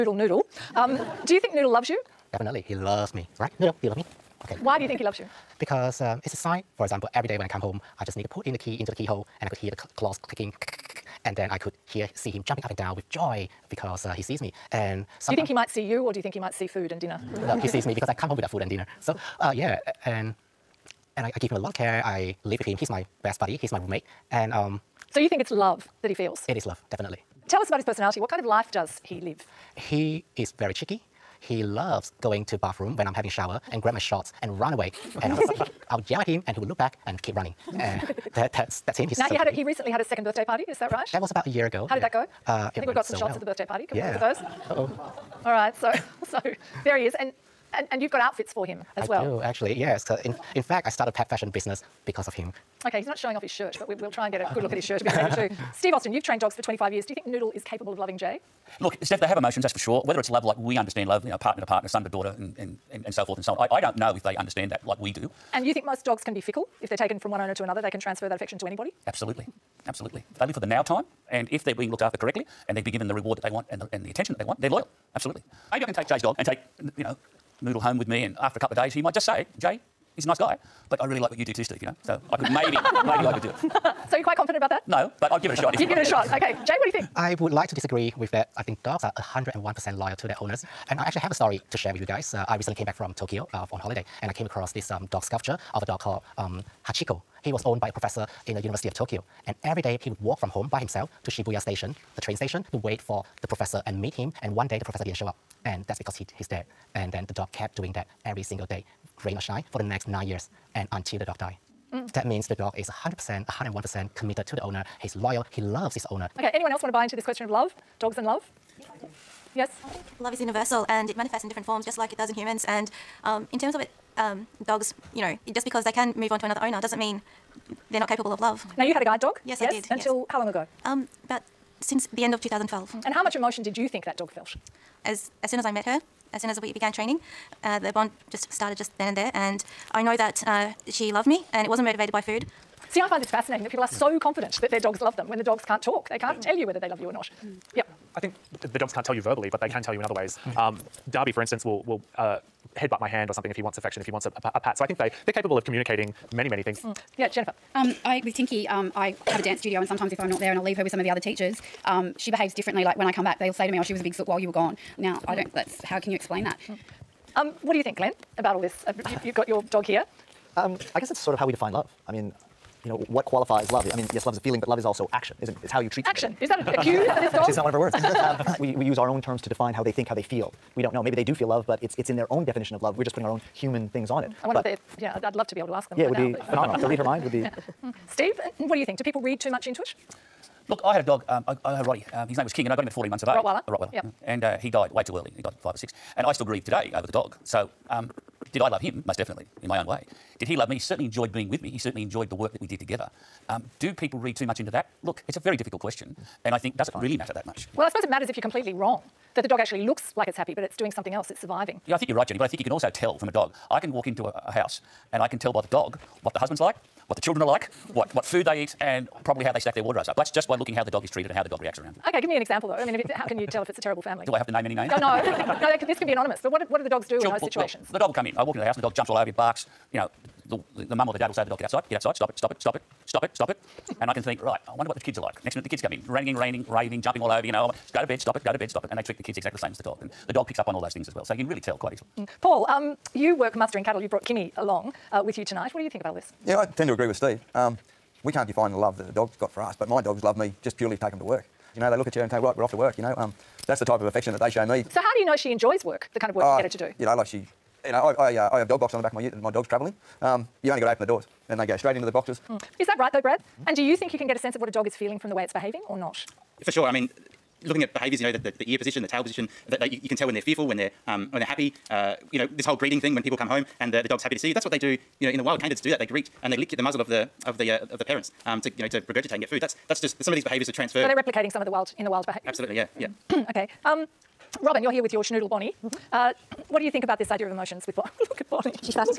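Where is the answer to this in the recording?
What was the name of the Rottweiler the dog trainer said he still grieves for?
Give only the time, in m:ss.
3:12.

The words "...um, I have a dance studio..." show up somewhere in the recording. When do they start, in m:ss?
2:38.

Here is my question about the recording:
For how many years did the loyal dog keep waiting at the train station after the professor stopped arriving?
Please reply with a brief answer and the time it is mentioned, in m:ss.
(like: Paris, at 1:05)
9, at 1:50.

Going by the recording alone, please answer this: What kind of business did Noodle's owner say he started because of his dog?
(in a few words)
Pet fashion business.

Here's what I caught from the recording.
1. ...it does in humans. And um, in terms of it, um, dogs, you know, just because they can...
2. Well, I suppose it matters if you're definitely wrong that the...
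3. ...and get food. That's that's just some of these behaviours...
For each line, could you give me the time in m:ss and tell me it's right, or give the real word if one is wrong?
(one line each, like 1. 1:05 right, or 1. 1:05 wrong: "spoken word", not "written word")
1. 2:02 right
2. 3:27 wrong: "completely", not "definitely"
3. 4:39 right.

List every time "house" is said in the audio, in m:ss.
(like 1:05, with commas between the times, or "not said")
3:34, 3:48.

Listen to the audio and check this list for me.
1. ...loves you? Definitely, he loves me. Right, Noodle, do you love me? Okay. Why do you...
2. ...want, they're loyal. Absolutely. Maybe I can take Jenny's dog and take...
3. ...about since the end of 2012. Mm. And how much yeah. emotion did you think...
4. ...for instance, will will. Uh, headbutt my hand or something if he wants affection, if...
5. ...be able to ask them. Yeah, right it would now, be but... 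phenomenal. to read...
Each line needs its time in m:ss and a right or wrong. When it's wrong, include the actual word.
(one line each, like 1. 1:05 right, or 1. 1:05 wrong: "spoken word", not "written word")
1. 0:01 right
2. 1:14 wrong: "Jay", not "Jenny"
3. 2:11 right
4. 2:31 right
5. 3:05 right.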